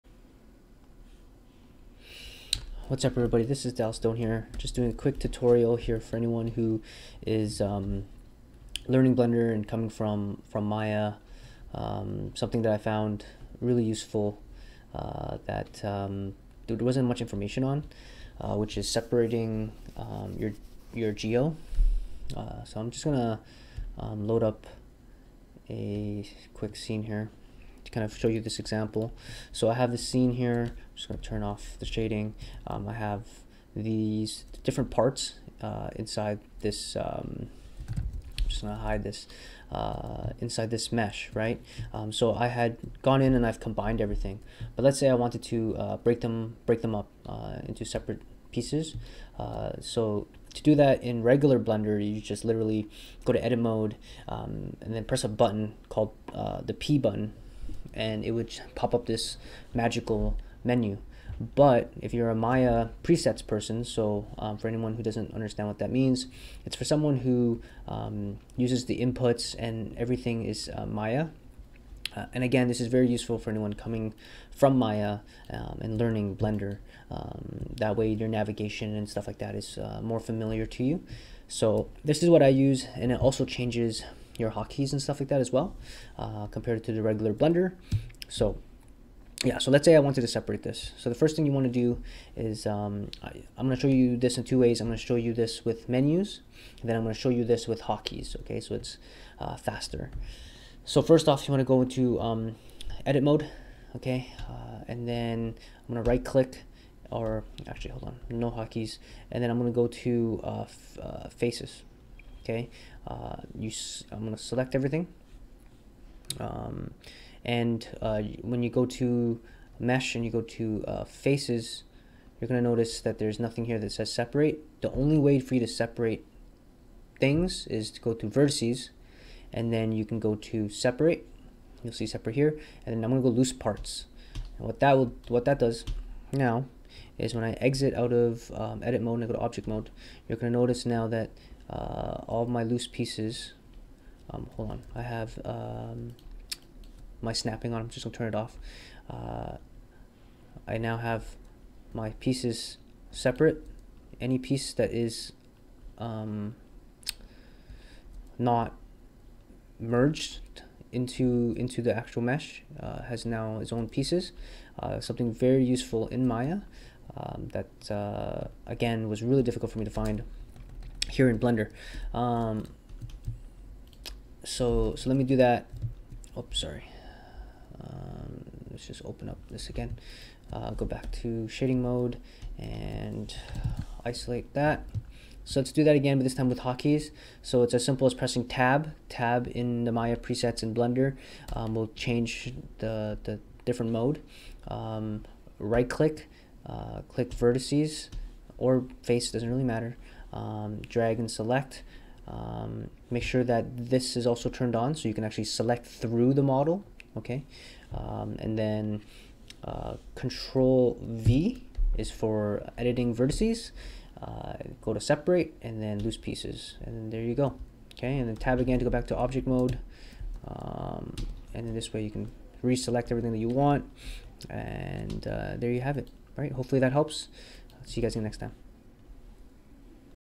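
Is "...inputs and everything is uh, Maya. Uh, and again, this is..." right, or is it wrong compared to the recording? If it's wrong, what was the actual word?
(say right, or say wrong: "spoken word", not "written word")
right.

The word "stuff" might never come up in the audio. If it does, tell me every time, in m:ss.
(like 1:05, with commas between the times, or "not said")
1:19, 1:25.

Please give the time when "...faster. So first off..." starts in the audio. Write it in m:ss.
1:39.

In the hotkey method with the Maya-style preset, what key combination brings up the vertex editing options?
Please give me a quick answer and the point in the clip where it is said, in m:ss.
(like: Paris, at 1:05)
Control V, at 3:30.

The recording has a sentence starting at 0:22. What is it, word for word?
Uh, so I'm just going to um, load up a quick scene here kind of show you this example.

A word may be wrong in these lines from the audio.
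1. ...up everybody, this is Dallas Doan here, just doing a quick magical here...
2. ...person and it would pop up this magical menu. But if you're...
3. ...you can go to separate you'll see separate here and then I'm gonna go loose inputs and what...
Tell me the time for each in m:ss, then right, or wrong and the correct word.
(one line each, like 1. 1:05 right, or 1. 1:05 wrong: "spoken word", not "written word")
1. 0:03 wrong: "tutorial", not "magical"
2. 0:56 wrong: "button", not "person"
3. 2:09 wrong: "parts", not "inputs".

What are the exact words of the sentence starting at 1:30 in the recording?
So the first thing you want to do is, um, I, am going to show you this in two ways.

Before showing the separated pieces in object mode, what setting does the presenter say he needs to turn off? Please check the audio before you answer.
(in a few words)
Snapping.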